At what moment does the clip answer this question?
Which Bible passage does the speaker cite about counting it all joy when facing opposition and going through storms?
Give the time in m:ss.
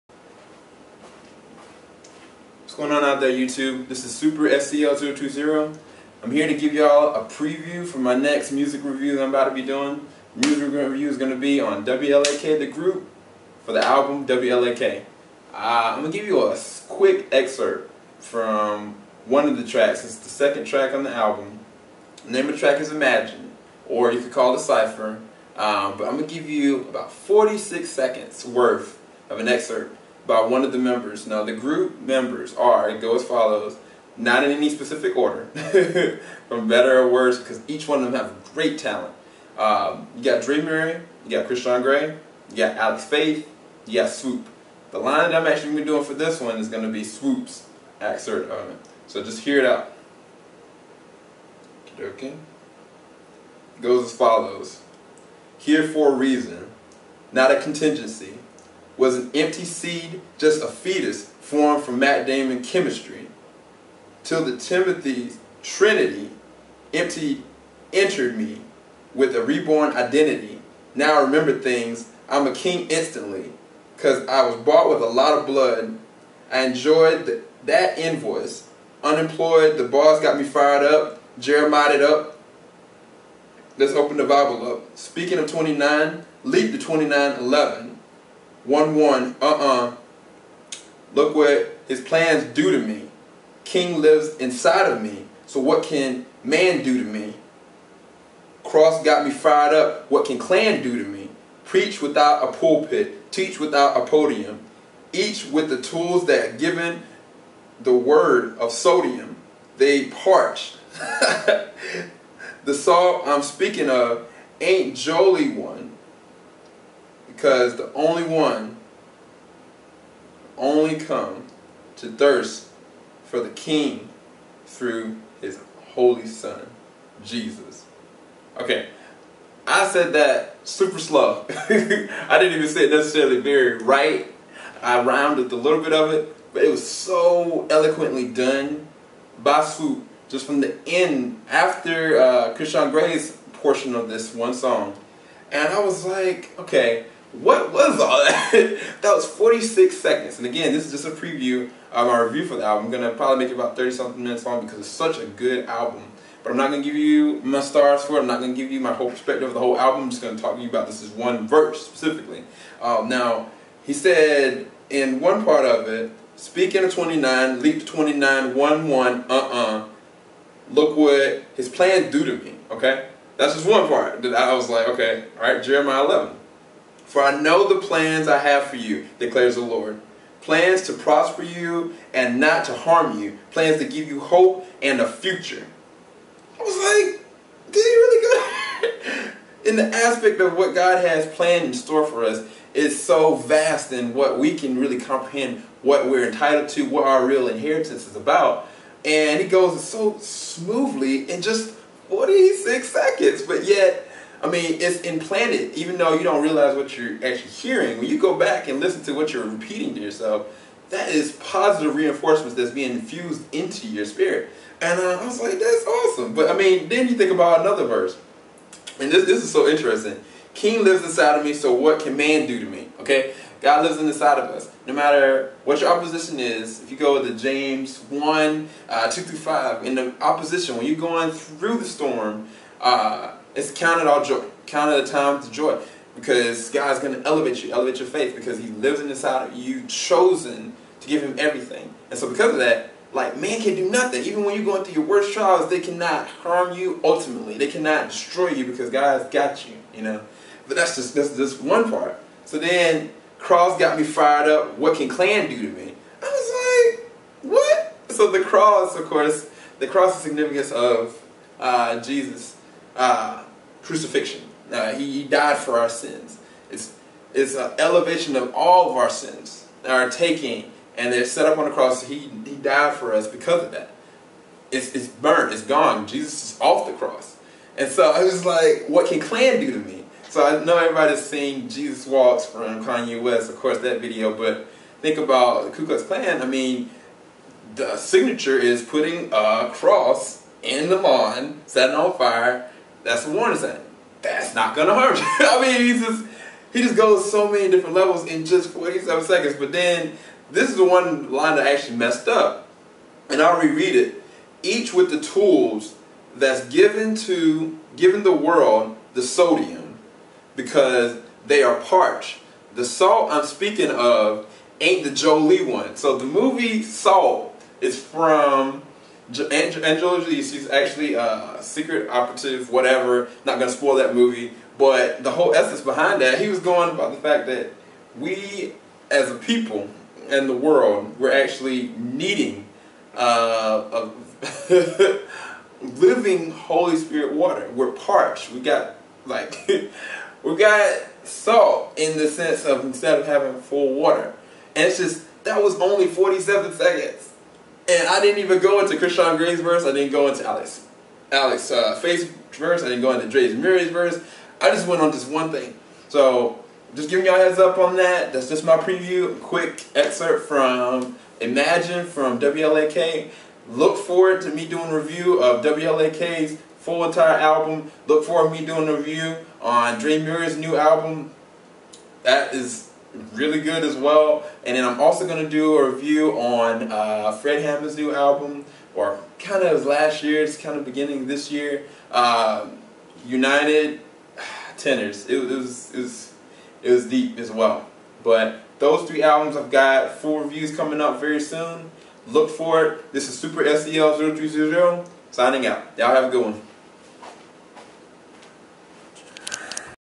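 3:47.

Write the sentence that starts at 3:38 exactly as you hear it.
And this, this is so interesting.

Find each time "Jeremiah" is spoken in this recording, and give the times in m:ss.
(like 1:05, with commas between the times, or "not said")
1:21, 2:55.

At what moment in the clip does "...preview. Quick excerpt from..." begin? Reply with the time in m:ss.
5:58.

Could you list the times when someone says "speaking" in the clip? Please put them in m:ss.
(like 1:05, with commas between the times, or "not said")
1:24, 1:53, 2:46, 5:13.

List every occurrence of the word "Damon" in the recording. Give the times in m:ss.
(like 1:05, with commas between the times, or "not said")
1:02.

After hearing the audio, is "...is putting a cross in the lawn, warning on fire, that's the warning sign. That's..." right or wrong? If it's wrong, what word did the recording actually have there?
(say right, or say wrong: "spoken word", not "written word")
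wrong: "setting", not "warning".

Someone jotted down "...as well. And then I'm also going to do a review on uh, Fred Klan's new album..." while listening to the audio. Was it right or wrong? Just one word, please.
wrong.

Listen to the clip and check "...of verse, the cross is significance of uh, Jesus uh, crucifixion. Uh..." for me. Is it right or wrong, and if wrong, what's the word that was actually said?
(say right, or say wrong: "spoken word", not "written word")
wrong: "course", not "verse".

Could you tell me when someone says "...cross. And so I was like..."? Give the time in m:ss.
4:36.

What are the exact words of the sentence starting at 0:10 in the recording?
music review is going to be on WLAK, the group, for the album WLAK.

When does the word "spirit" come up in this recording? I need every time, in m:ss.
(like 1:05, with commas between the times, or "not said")
3:34, 5:36.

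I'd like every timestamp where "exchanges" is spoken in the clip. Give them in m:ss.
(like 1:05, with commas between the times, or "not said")
not said.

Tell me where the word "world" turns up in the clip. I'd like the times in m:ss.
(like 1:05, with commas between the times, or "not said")
5:08, 5:30.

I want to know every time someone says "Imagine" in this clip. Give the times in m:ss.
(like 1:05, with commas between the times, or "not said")
0:22, 6:01.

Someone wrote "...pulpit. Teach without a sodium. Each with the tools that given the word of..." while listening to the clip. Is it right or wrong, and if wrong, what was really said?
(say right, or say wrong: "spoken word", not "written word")
wrong: "podium", not "sodium".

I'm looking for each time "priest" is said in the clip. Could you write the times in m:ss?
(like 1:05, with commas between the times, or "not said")
not said.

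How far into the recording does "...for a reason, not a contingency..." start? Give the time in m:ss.
0:55.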